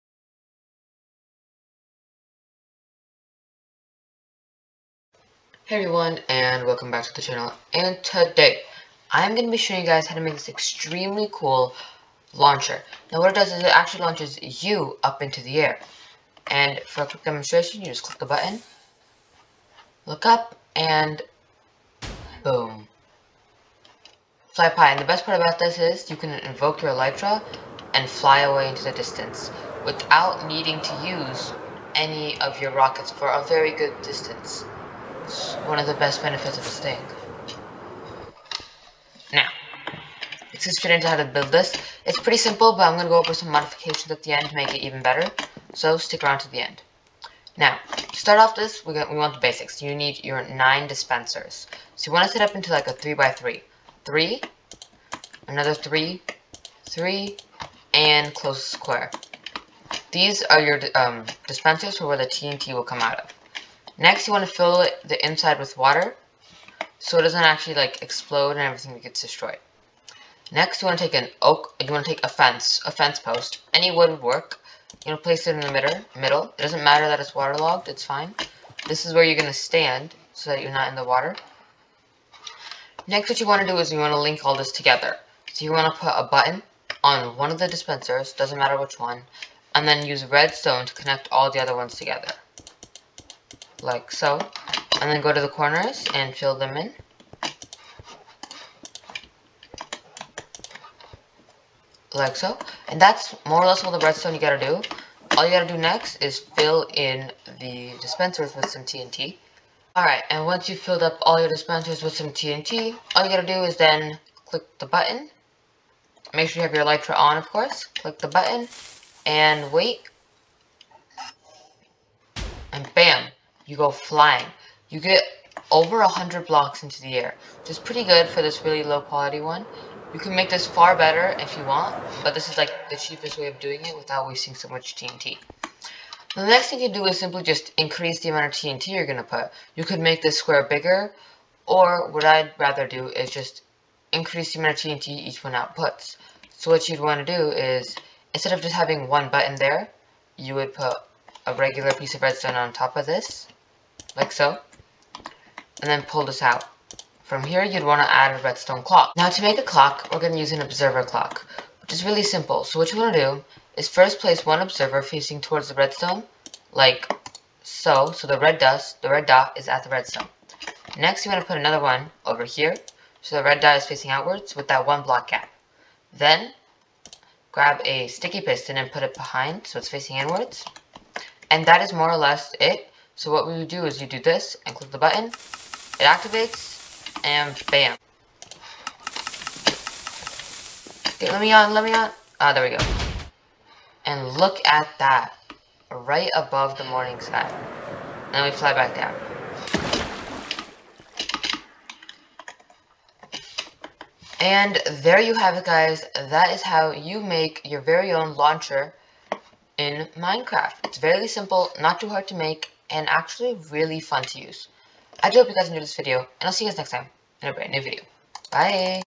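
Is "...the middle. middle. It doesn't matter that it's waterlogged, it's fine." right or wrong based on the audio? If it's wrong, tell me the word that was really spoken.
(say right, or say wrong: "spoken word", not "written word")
right.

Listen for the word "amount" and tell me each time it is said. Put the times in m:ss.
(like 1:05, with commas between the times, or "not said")
2:18, 2:24.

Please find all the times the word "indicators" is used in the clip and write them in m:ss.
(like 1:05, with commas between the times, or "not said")
not said.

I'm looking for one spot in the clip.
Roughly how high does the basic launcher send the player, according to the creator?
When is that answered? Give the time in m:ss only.
2:05.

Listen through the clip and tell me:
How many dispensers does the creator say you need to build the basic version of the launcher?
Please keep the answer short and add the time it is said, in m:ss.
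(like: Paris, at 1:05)
9, at 0:50.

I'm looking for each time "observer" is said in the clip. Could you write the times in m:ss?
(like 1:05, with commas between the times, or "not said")
2:40, 2:44.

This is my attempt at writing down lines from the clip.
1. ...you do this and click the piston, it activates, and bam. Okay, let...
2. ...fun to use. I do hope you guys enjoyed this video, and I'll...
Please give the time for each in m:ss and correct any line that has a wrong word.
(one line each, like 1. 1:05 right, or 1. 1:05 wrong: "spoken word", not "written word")
1. 3:04 wrong: "button", not "piston"
2. 3:33 right.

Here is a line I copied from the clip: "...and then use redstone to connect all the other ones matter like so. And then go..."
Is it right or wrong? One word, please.
wrong.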